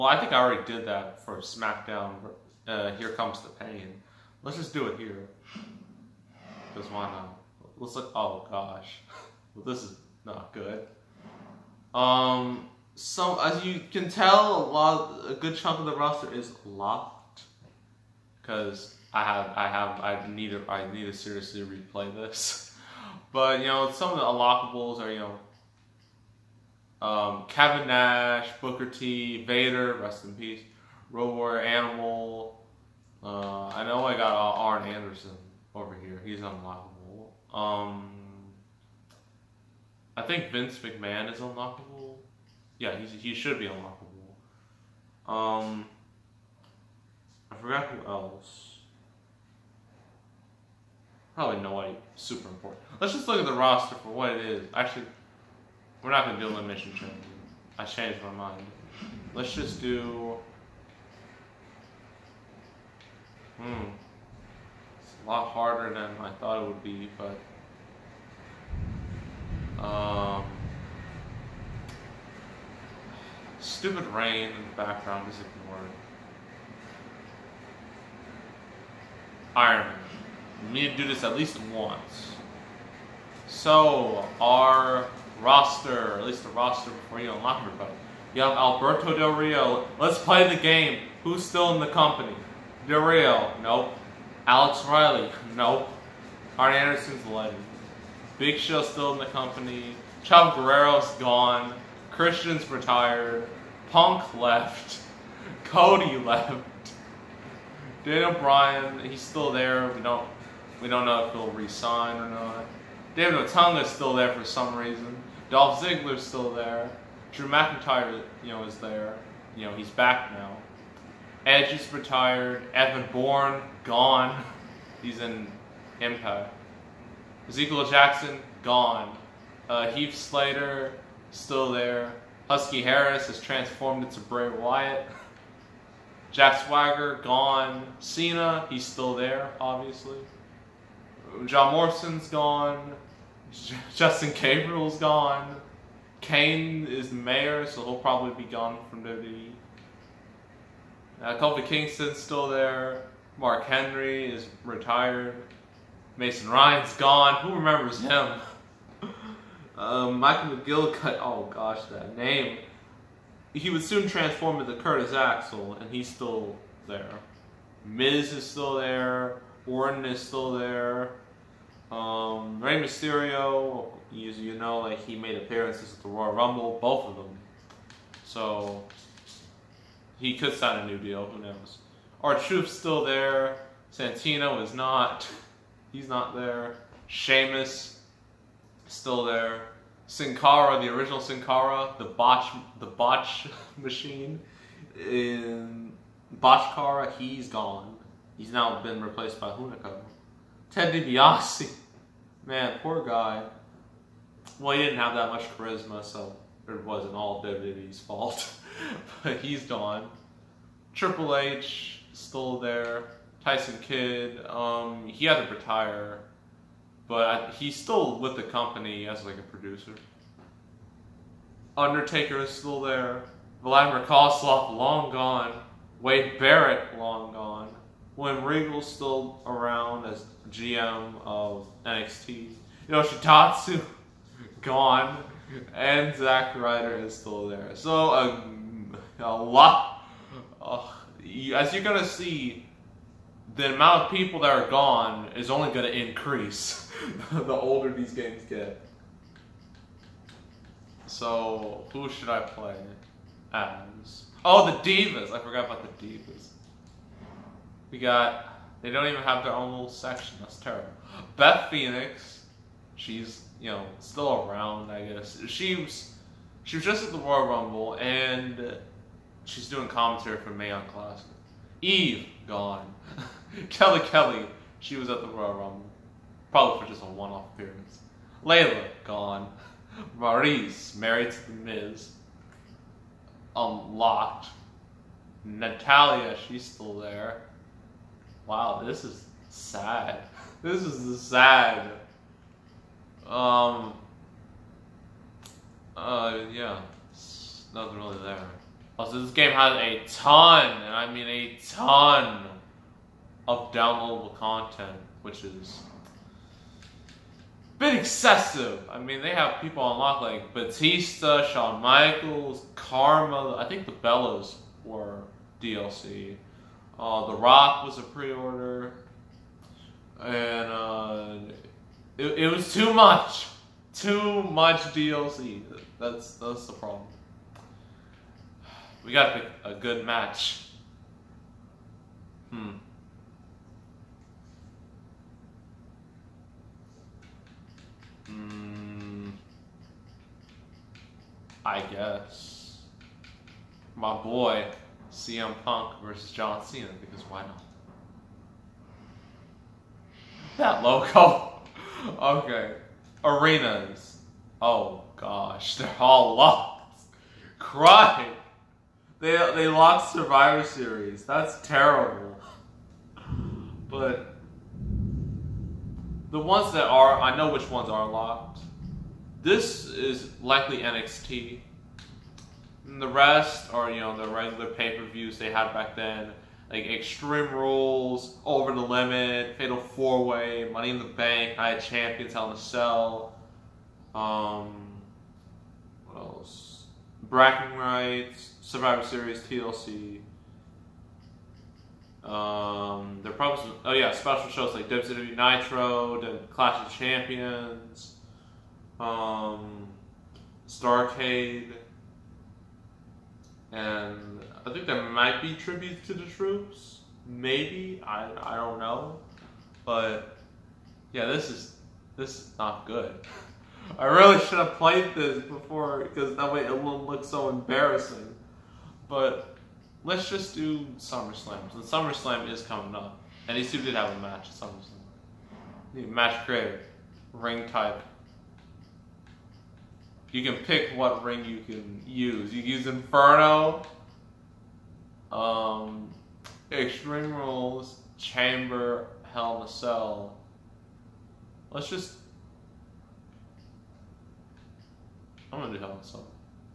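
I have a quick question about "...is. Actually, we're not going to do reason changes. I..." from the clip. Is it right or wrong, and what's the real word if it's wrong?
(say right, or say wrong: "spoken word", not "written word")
wrong: "elimination", not "reason".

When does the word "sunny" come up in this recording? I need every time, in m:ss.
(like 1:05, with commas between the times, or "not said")
not said.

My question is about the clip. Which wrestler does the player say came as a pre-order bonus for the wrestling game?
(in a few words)
The Rock.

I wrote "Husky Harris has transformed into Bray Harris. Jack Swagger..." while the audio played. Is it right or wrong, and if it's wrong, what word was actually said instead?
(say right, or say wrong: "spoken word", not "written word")
wrong: "Wyatt", not "Harris".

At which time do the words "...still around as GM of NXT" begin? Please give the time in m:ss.
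3:48.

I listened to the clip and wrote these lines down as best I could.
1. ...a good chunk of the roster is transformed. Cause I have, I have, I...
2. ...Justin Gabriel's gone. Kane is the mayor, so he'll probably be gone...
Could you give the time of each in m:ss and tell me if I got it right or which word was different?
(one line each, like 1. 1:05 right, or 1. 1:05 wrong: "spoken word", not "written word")
1. 0:15 wrong: "locked", not "transformed"
2. 2:23 right.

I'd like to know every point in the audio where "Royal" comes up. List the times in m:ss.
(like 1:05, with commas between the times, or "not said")
2:56, 4:27, 4:35.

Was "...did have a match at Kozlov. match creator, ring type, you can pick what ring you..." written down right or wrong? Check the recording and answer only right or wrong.
wrong.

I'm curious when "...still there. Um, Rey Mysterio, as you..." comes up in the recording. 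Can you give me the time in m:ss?
2:50.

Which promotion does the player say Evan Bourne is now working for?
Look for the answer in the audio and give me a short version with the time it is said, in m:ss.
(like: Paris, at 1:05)
Impact, at 2:06.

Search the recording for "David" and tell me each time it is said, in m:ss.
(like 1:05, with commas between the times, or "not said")
1:53.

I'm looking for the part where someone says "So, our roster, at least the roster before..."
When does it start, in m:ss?
1:23.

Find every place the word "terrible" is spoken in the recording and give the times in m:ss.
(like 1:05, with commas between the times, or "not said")
4:20, 6:01.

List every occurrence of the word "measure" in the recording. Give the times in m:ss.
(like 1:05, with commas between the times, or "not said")
not said.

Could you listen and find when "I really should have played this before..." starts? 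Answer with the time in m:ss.
6:53.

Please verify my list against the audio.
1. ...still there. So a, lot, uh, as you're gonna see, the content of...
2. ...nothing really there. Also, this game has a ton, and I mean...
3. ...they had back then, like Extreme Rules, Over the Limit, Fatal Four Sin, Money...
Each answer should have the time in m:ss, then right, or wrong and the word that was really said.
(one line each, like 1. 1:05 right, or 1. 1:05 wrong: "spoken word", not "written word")
1. 3:57 wrong: "amount", not "content"
2. 4:57 right
3. 6:15 wrong: "Way", not "Sin".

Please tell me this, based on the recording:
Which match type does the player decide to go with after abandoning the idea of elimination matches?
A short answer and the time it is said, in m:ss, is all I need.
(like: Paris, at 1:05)
Iron Man, at 1:19.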